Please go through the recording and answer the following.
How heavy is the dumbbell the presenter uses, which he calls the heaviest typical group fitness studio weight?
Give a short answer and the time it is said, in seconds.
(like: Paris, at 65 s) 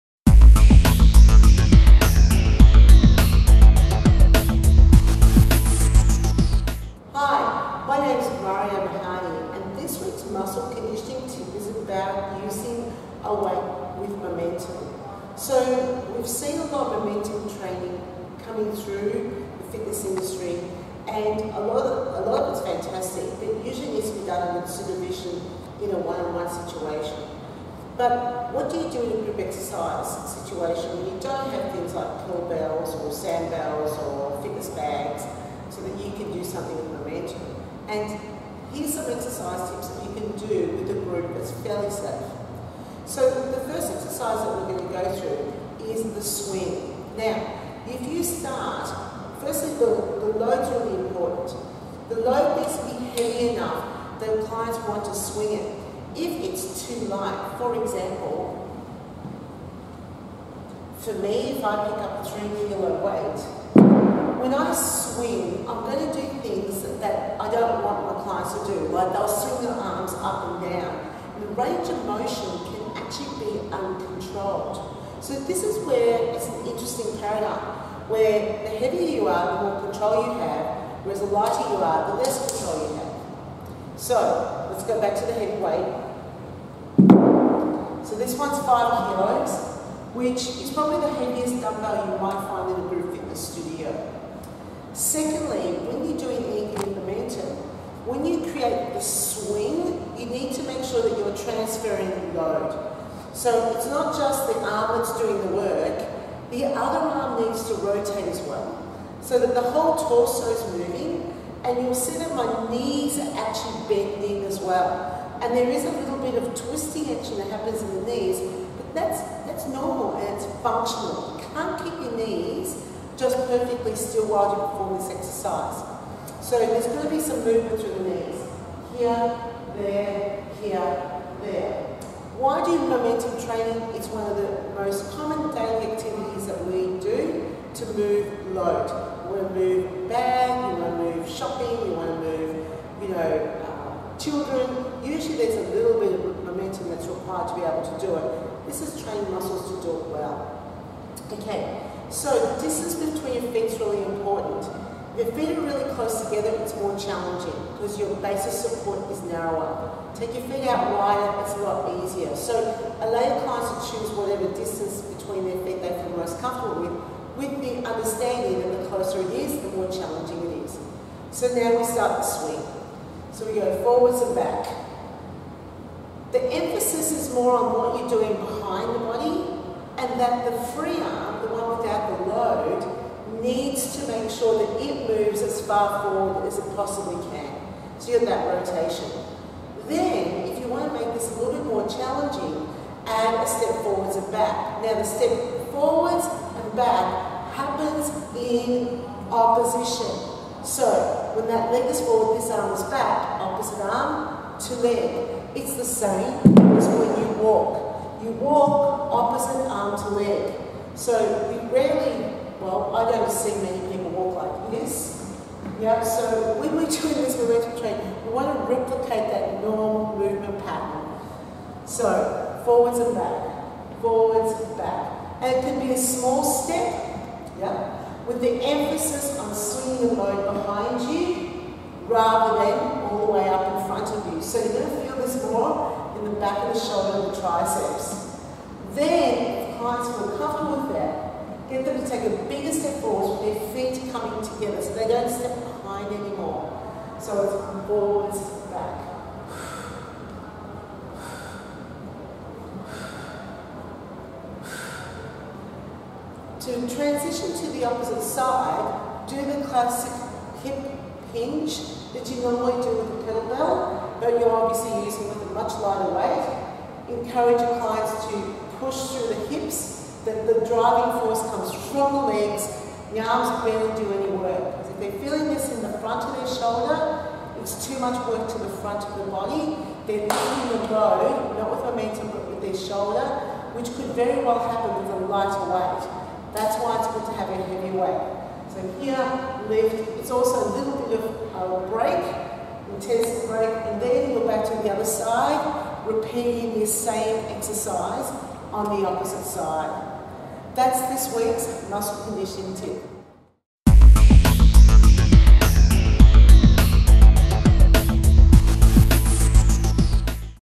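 5 kilos, at 88 s.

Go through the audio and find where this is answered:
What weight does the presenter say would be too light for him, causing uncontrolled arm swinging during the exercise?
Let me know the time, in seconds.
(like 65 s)
62 s.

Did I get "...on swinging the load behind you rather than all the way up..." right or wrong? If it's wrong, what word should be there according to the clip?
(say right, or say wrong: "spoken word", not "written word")
right.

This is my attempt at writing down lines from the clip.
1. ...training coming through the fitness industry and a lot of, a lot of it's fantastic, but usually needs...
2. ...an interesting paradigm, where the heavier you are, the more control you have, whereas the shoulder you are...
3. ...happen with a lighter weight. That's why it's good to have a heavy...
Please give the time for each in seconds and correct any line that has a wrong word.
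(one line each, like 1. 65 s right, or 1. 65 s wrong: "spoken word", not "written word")
1. 17 s right
2. 76 s wrong: "lighter", not "shoulder"
3. 284 s right.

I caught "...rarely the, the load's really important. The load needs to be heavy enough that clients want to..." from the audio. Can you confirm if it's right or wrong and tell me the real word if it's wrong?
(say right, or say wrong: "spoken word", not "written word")
wrong: "firstly", not "rarely".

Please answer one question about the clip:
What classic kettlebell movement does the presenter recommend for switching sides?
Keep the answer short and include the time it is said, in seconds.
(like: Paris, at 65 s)
hip hinge, at 260 s.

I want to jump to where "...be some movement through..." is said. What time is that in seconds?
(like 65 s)
127 s.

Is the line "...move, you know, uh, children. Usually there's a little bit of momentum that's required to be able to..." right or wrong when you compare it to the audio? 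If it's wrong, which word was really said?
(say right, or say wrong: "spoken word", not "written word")
right.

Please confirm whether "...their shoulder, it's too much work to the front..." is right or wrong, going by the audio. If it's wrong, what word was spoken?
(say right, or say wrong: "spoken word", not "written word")
right.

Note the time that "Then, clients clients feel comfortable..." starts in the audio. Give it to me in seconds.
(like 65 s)
238 s.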